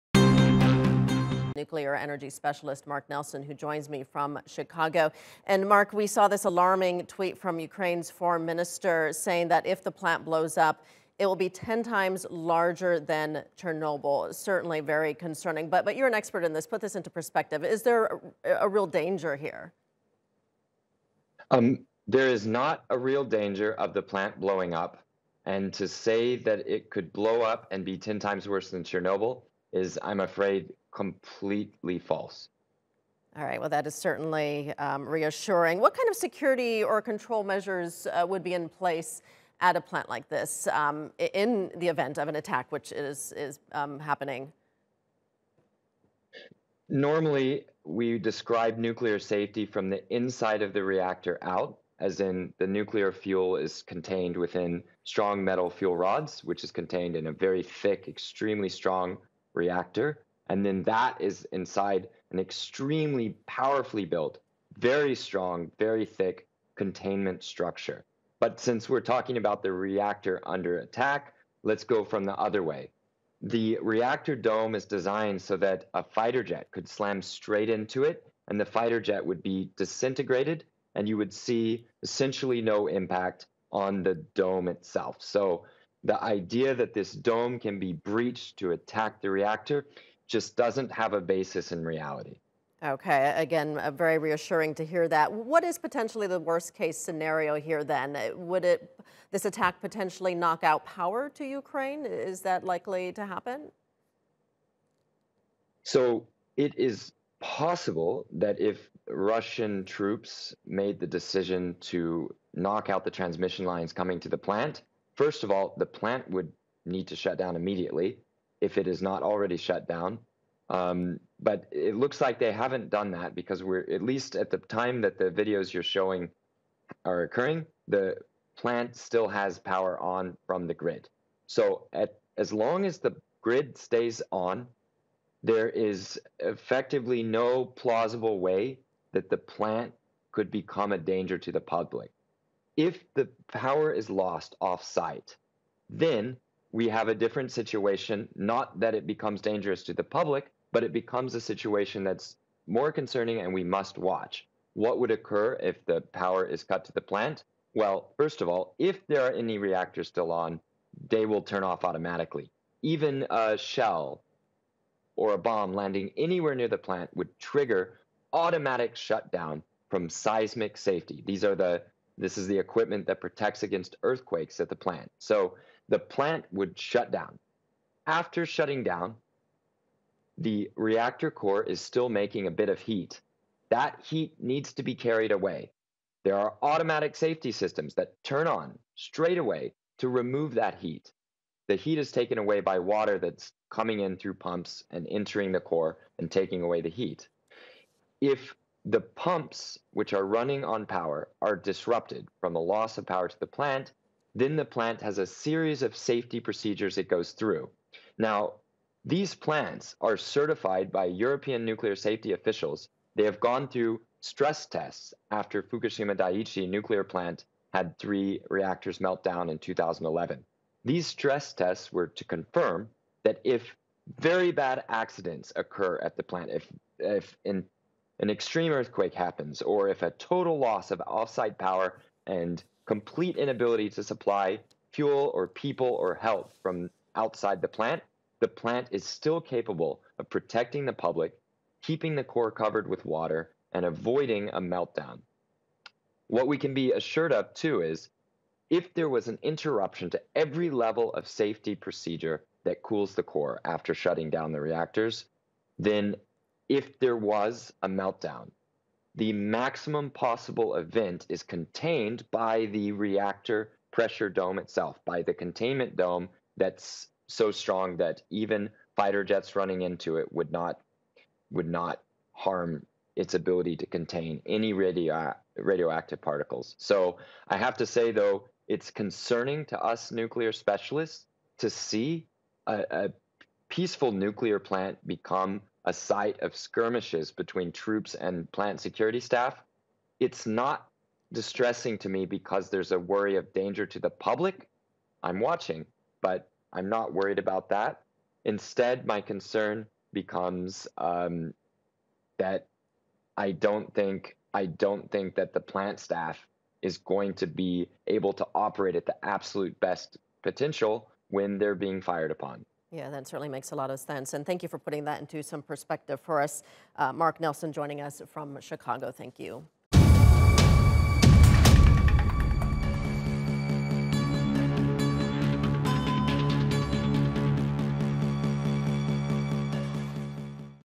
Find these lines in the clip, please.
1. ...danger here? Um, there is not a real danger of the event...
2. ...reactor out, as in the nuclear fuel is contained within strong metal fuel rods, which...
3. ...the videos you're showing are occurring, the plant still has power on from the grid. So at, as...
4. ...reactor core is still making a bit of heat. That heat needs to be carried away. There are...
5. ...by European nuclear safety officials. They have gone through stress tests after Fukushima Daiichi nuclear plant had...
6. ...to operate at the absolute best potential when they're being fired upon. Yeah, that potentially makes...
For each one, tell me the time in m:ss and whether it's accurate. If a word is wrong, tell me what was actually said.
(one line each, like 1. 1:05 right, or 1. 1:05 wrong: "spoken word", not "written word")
1. 0:18 wrong: "plant", not "event"
2. 0:50 right
3. 2:05 right
4. 3:00 right
5. 3:30 right
6. 5:08 wrong: "certainly", not "potentially".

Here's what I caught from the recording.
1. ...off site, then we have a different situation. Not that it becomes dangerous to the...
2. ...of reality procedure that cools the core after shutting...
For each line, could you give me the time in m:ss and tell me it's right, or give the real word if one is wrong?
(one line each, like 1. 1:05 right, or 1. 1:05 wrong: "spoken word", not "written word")
1. 2:24 right
2. 4:11 wrong: "safety", not "reality".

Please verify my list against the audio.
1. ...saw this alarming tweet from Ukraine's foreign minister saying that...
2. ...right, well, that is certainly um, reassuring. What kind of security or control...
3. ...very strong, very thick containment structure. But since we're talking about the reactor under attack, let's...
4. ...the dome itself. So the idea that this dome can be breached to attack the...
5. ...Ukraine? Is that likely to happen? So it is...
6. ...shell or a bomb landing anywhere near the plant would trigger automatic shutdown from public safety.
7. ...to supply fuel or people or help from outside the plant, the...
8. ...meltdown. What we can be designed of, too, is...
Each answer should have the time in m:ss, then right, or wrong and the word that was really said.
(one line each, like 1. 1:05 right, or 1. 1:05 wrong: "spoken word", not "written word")
1. 0:06 right
2. 0:33 right
3. 1:04 right
4. 1:24 right
5. 1:41 right
6. 2:43 wrong: "seismic", not "public"
7. 3:53 right
8. 4:04 wrong: "assured", not "designed".